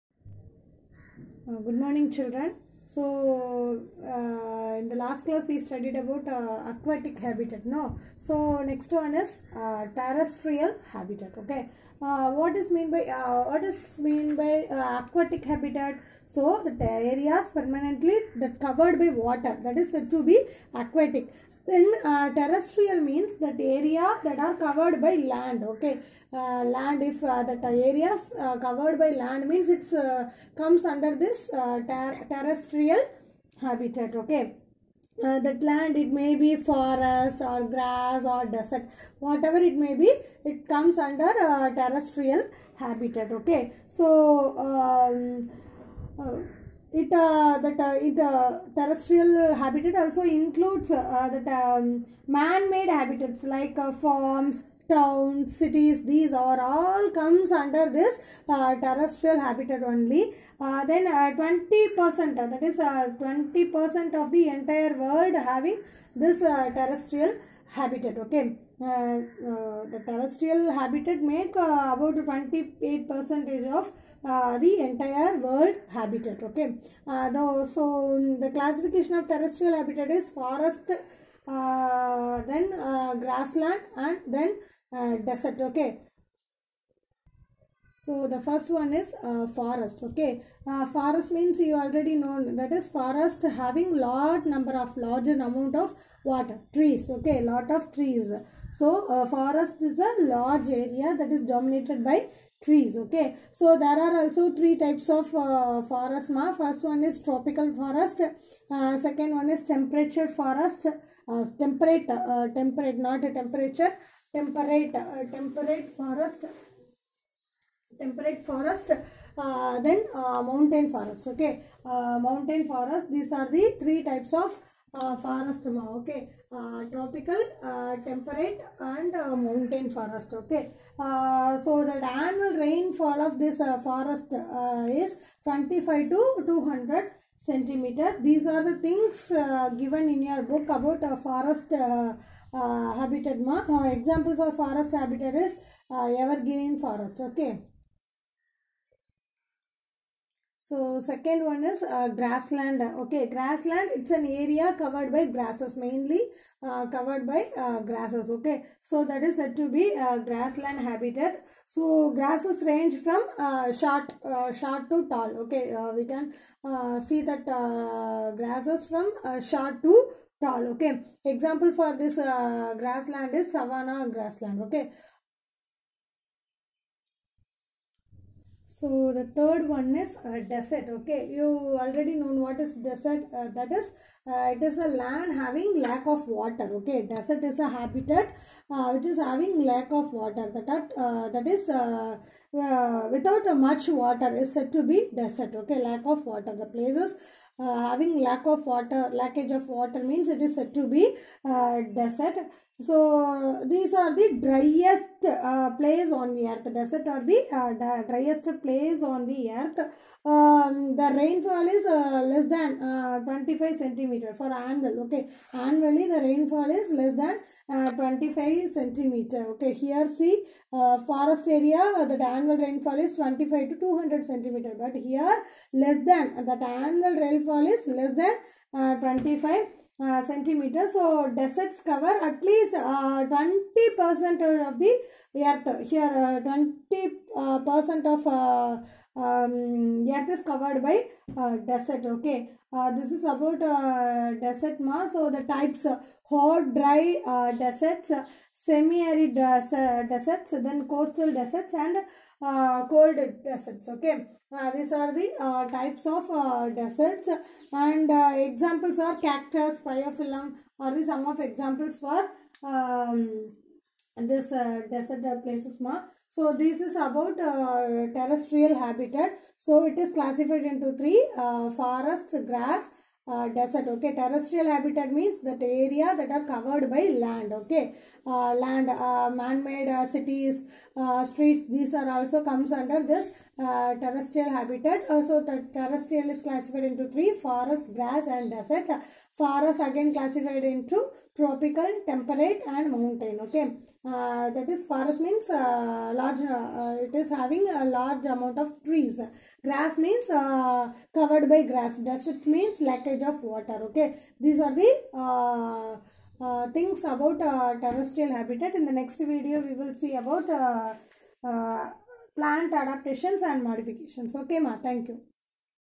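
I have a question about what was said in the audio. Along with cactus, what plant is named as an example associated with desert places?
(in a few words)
Bryophyllum.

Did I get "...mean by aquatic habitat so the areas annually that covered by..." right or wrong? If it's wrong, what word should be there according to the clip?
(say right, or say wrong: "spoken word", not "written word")
wrong: "permanently", not "annually".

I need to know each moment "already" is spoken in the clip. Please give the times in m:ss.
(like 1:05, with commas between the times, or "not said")
1:31, 3:01.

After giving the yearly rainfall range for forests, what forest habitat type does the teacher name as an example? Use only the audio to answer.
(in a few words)
Evergreen forest.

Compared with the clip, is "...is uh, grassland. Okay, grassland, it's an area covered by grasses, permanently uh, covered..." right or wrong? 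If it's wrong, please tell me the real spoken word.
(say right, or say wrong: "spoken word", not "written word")
wrong: "mainly", not "permanently".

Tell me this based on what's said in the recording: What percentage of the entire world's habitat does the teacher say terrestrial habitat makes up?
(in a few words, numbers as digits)
28 percent.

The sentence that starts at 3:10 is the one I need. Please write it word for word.
That uh, that is without much water is said to be desert.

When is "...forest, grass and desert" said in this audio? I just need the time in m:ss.
4:47.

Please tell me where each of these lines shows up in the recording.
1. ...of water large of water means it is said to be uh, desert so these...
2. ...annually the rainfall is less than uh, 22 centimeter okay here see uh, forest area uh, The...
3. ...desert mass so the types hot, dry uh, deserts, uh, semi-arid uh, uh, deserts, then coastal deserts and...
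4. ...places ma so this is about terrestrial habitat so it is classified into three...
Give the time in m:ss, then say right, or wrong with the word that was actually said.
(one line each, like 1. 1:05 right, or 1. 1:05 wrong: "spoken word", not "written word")
1. 3:18 wrong: "lackage", not "large"
2. 3:35 wrong: "25", not "22"
3. 4:04 right
4. 4:25 right.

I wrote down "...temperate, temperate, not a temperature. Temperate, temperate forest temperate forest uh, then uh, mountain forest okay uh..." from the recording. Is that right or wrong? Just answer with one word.
right.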